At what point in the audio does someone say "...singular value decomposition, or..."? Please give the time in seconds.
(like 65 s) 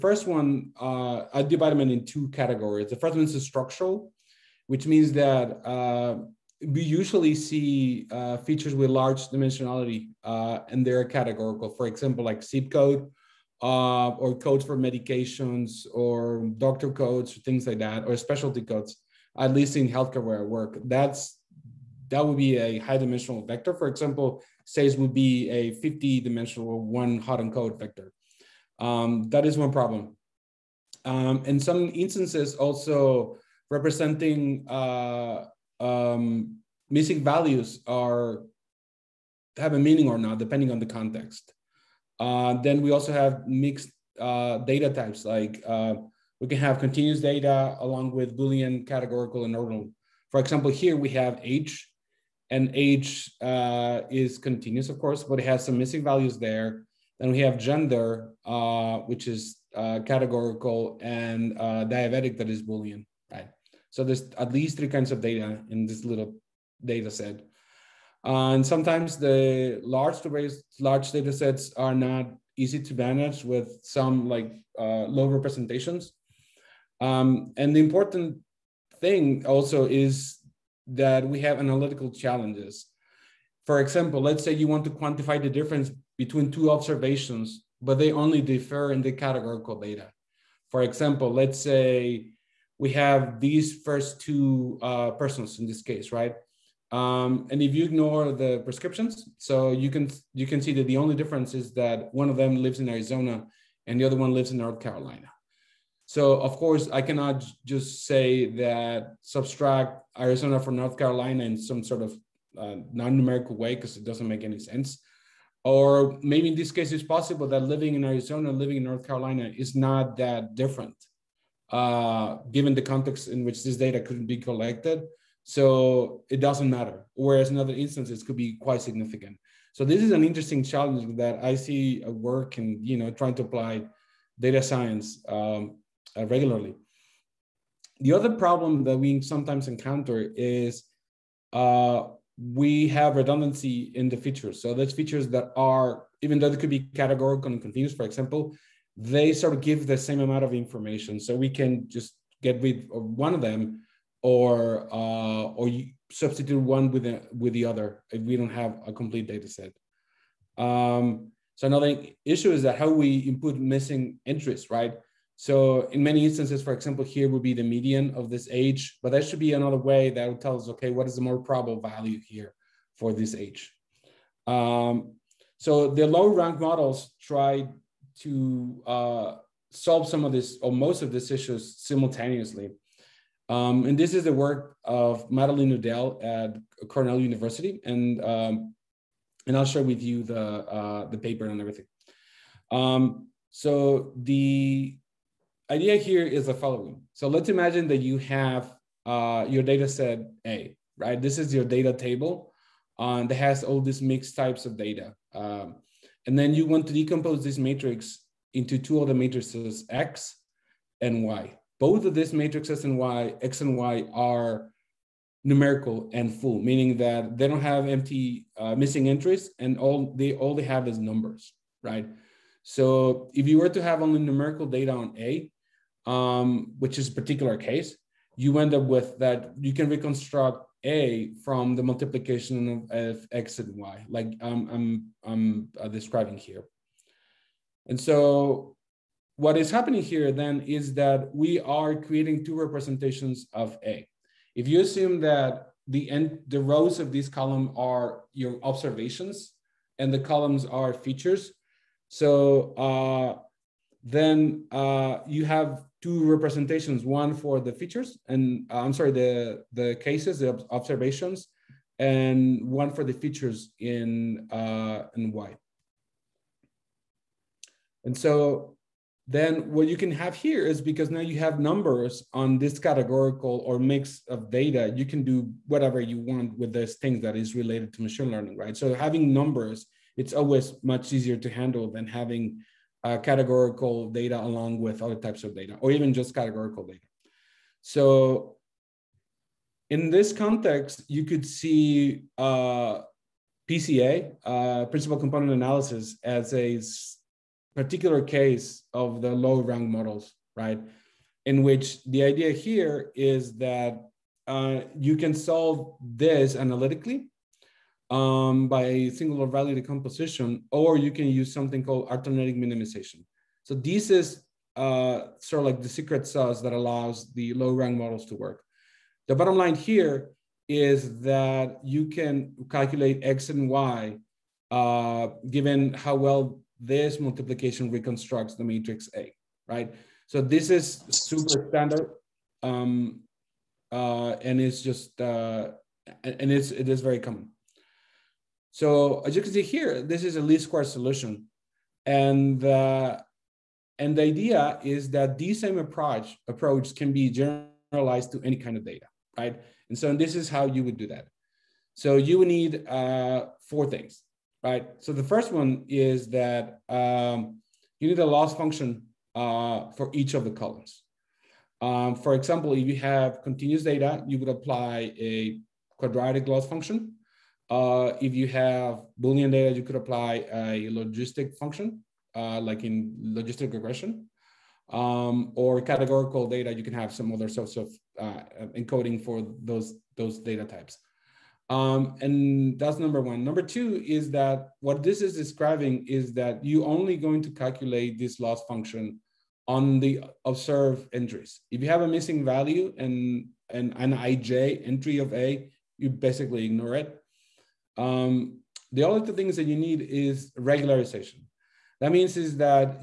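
309 s.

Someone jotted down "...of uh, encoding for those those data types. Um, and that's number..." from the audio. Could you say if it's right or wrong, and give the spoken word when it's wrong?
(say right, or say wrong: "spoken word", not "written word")
right.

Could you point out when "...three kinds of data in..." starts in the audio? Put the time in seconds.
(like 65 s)
64 s.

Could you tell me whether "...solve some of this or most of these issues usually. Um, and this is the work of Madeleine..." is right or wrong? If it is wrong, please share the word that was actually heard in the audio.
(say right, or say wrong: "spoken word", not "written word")
wrong: "simultaneously", not "usually".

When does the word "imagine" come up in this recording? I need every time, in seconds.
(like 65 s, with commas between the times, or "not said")
197 s.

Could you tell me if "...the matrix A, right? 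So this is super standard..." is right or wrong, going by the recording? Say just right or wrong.
right.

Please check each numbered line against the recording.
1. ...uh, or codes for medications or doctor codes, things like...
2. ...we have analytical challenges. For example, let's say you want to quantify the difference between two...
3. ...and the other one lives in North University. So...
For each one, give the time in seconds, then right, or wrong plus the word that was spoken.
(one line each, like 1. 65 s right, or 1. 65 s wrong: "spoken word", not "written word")
1. 13 s right
2. 81 s right
3. 103 s wrong: "Carolina", not "University".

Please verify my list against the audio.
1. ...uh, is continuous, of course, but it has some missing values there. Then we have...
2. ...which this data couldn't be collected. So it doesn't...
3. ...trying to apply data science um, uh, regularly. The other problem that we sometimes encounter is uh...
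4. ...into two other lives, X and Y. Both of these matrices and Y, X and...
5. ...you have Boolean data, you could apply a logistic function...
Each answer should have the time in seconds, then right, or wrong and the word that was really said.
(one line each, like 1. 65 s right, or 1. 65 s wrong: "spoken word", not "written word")
1. 53 s right
2. 123 s right
3. 133 s right
4. 208 s wrong: "matrices", not "lives"
5. 368 s right.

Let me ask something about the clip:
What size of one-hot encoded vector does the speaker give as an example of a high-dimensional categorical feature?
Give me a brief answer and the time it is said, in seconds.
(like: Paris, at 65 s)
50, at 25 s.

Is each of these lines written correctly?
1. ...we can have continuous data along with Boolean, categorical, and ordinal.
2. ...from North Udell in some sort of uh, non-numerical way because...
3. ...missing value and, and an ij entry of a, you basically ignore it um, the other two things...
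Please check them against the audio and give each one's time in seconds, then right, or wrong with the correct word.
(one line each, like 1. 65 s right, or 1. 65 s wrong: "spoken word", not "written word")
1. 46 s right
2. 110 s wrong: "Carolina", not "Udell"
3. 392 s right.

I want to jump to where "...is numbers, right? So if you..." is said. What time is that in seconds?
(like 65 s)
220 s.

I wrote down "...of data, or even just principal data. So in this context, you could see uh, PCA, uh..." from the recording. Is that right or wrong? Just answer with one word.
wrong.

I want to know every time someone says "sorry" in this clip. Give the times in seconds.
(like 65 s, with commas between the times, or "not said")
258 s.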